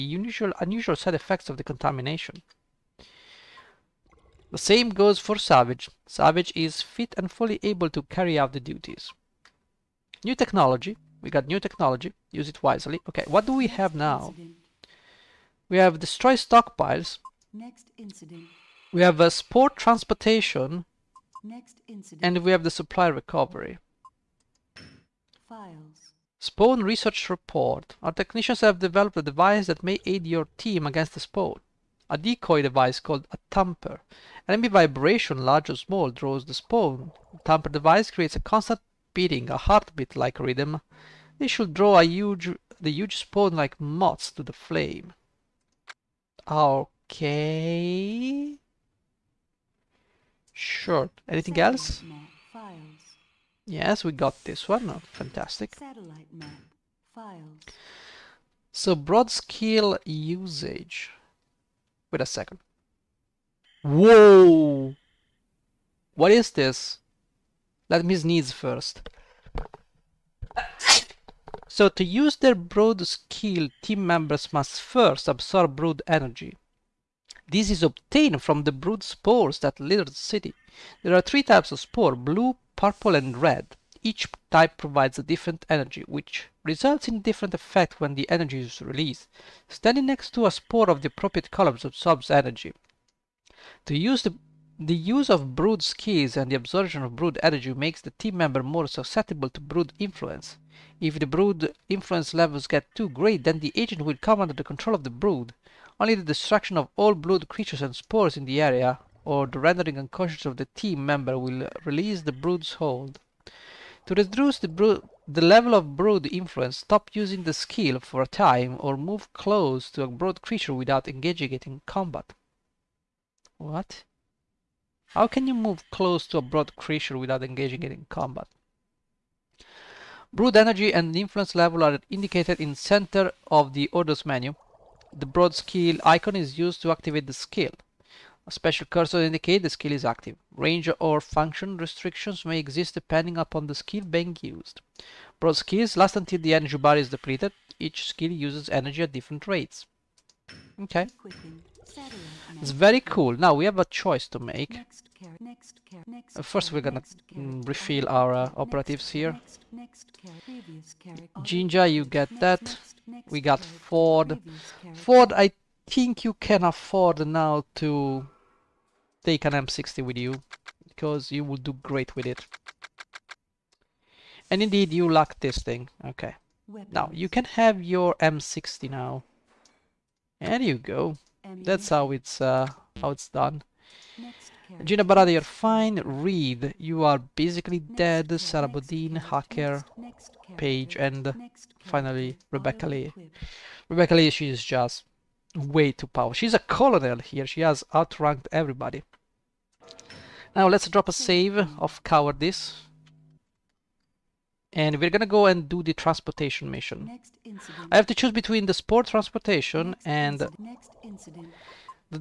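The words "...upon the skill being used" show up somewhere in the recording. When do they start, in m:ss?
2:23.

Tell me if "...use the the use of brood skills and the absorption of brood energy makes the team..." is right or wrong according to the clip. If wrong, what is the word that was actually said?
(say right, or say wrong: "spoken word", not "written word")
right.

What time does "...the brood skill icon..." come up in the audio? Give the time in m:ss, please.
2:15.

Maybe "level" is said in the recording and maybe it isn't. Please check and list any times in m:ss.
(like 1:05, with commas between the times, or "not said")
1:42, 1:55, 2:11.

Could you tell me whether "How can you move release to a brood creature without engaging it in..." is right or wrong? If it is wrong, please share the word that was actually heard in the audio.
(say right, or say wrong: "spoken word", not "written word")
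wrong: "close", not "release".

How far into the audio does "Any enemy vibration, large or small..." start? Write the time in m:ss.
0:34.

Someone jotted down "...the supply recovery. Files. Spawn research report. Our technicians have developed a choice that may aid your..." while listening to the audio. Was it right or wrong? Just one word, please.
wrong.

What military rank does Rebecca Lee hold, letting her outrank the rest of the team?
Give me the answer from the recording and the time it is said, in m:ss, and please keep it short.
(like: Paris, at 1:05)
Colonel, at 3:16.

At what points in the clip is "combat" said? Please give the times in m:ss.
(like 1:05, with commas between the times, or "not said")
2:01, 2:08.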